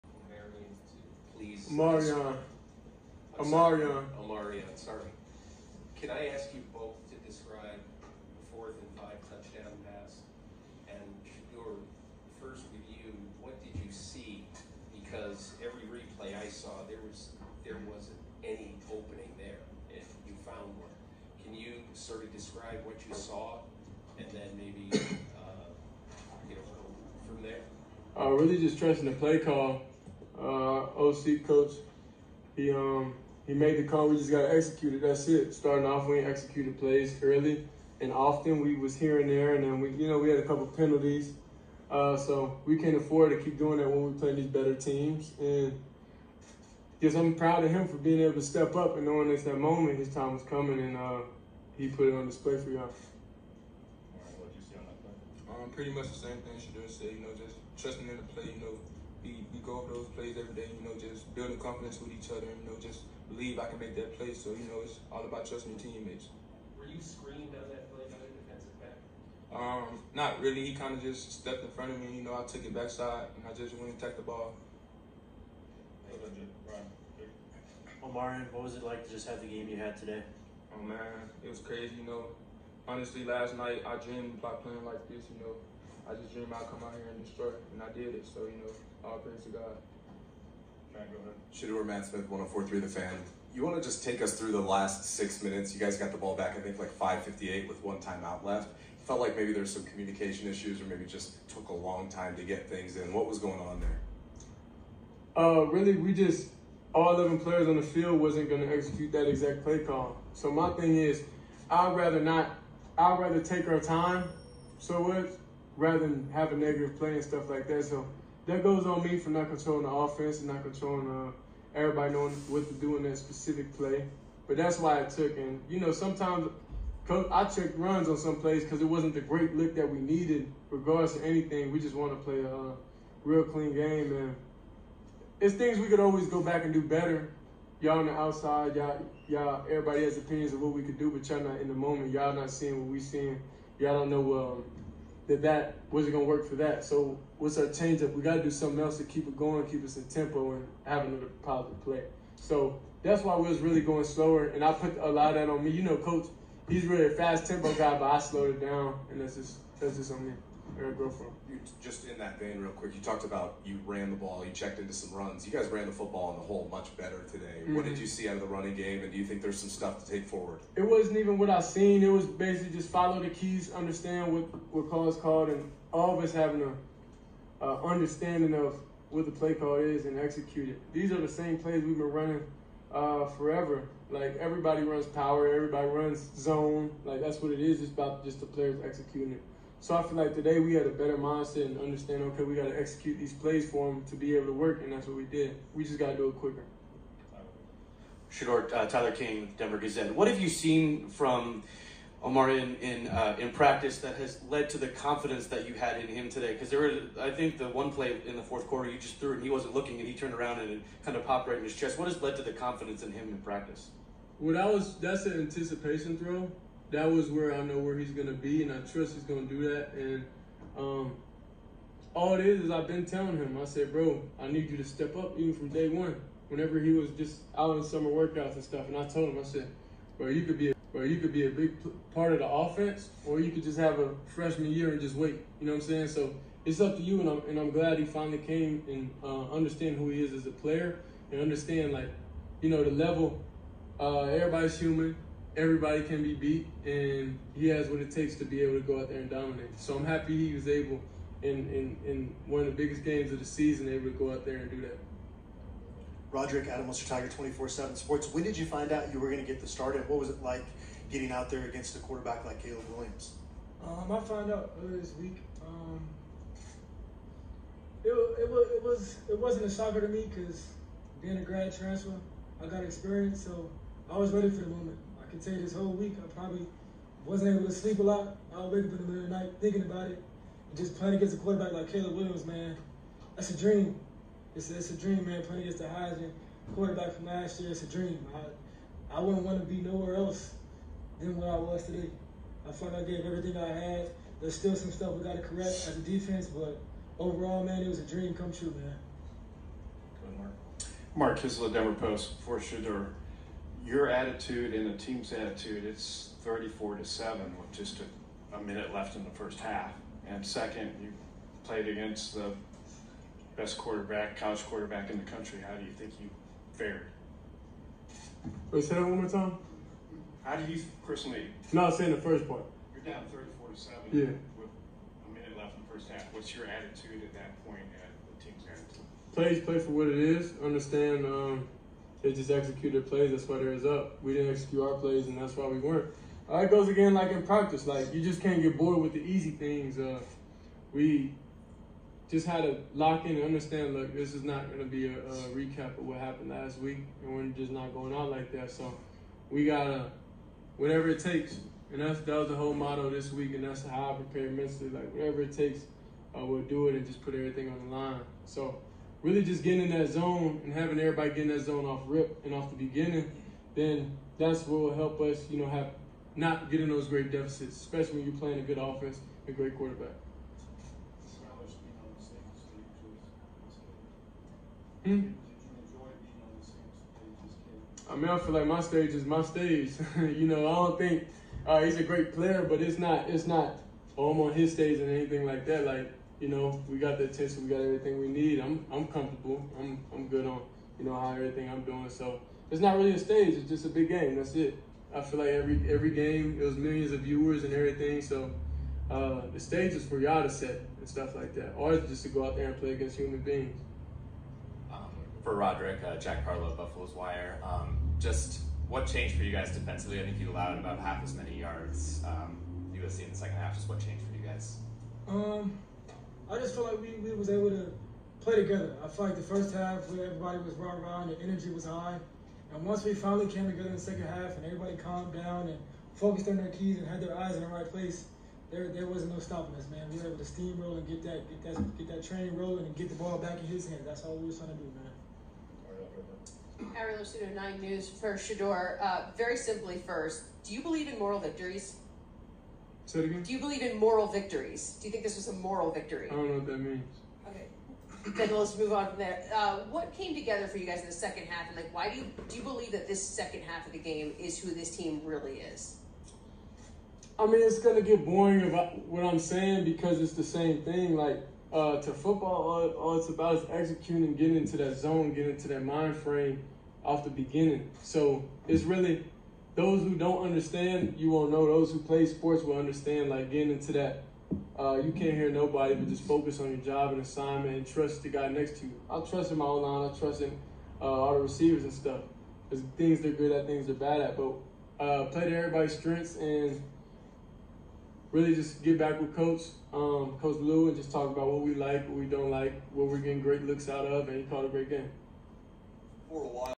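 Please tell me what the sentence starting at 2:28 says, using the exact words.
We gotta do something else to keep it going, keep us in tempo, and have another positive play.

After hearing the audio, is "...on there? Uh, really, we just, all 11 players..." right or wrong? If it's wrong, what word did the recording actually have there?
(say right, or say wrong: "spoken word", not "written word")
right.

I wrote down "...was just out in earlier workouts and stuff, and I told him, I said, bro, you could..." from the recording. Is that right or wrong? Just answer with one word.
wrong.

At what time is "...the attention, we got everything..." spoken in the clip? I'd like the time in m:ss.
6:27.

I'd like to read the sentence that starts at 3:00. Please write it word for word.
These are the same plays we've been running uh, forever.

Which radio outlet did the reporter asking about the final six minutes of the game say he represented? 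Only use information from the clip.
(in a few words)
1043 The Fan.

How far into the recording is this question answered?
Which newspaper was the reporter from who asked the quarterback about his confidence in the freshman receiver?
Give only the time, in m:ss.
3:19.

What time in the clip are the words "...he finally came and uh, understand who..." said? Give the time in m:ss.
3:57.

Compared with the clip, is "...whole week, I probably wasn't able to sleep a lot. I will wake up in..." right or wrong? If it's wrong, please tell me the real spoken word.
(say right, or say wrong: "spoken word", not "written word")
right.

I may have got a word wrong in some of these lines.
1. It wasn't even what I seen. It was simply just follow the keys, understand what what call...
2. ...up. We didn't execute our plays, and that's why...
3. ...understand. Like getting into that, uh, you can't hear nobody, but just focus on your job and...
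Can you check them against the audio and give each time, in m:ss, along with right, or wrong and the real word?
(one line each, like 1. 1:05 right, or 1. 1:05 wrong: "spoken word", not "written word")
1. 2:50 wrong: "basically", not "simply"
2. 5:33 right
3. 7:52 right.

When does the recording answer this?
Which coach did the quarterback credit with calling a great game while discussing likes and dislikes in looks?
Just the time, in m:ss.
8:10.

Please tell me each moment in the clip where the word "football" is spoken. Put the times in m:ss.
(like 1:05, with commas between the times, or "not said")
2:45, 7:42.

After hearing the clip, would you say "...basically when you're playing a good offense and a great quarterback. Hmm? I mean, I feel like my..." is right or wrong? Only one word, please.
wrong.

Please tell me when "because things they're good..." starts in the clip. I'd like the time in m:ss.
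8:02.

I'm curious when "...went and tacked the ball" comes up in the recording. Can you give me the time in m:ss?
1:13.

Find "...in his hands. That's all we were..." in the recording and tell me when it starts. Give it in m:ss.
7:13.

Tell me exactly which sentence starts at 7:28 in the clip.
then let's move on from there.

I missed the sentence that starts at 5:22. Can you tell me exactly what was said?
You're down 34 to 7 yeah.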